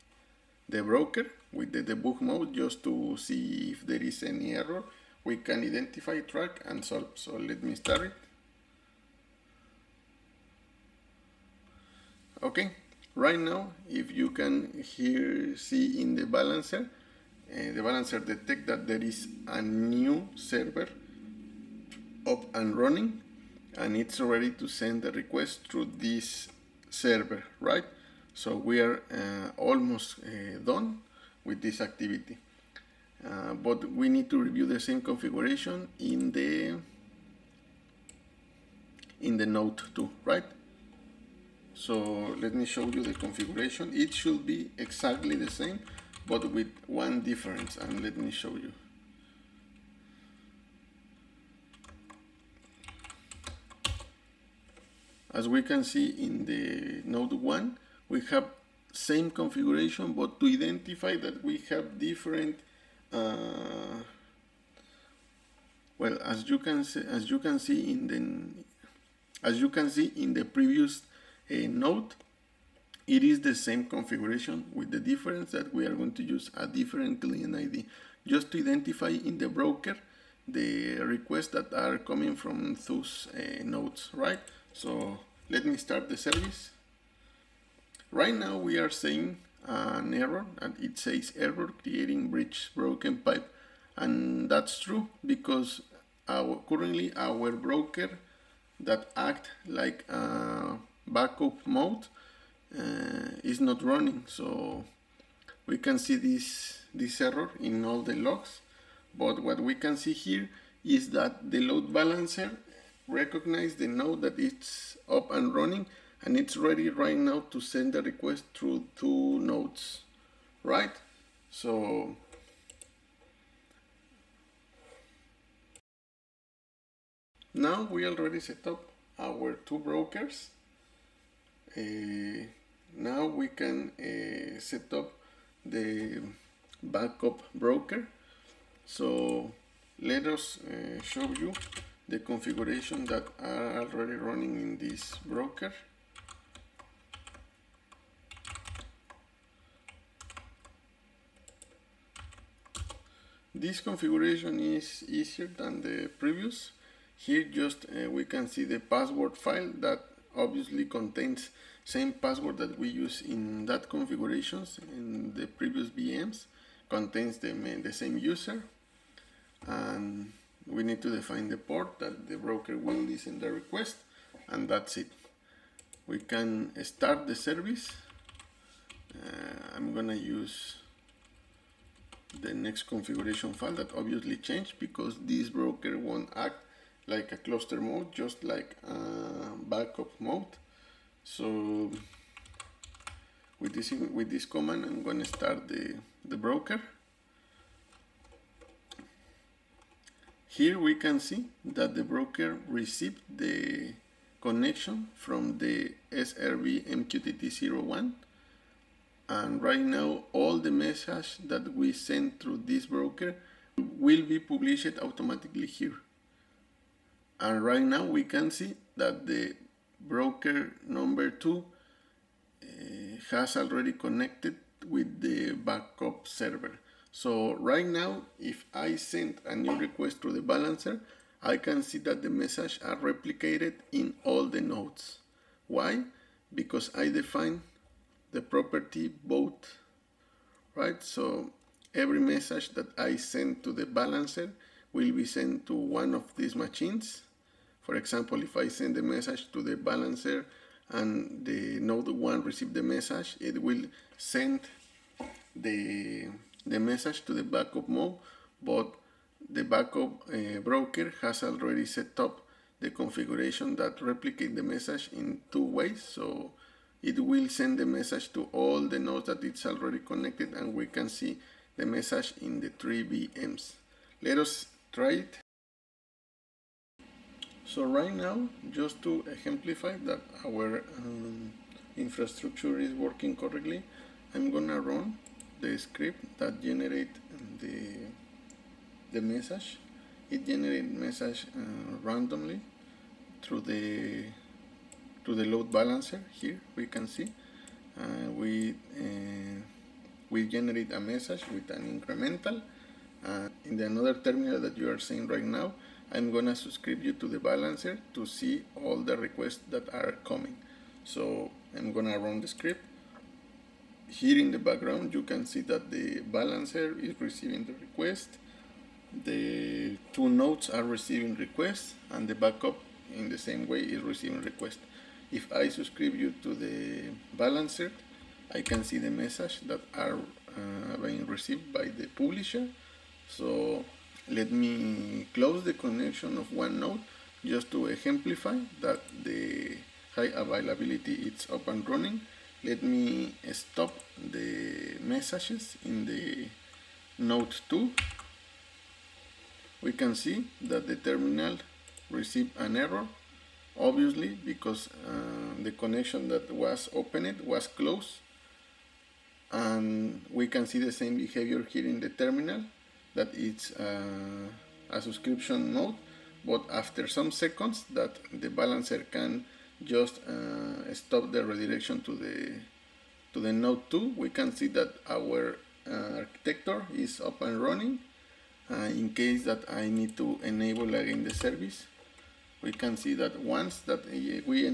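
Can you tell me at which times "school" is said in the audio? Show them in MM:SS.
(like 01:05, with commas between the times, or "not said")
not said.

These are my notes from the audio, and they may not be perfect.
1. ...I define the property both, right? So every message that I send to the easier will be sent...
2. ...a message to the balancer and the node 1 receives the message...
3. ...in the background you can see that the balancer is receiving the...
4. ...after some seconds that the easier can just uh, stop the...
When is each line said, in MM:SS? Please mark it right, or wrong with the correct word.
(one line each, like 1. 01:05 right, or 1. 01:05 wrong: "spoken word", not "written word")
1. 03:56 wrong: "balancer", not "easier"
2. 04:08 right
3. 05:14 right
4. 06:06 wrong: "balancer", not "easier".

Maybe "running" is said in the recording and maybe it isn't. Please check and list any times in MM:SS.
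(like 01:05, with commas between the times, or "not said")
00:22, 01:43, 01:55, 02:24, 05:41, 06:17.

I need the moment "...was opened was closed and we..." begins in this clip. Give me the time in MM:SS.
05:56.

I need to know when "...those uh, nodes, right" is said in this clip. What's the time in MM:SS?
01:22.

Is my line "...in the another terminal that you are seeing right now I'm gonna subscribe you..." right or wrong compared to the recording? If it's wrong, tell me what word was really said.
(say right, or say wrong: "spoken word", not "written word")
right.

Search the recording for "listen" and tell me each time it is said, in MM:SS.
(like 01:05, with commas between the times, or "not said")
02:52.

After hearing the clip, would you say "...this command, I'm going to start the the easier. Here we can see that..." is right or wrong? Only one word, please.
wrong.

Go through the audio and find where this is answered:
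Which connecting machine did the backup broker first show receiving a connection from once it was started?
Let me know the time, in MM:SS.
03:26.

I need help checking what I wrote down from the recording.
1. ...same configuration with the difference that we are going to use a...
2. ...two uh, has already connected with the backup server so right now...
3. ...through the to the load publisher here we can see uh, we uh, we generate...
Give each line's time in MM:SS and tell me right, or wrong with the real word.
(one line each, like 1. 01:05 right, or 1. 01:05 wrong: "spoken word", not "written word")
1. 01:13 right
2. 03:41 right
3. 04:53 wrong: "balancer", not "publisher".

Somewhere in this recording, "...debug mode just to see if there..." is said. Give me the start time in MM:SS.
00:01.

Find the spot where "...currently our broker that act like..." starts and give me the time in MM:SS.
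01:36.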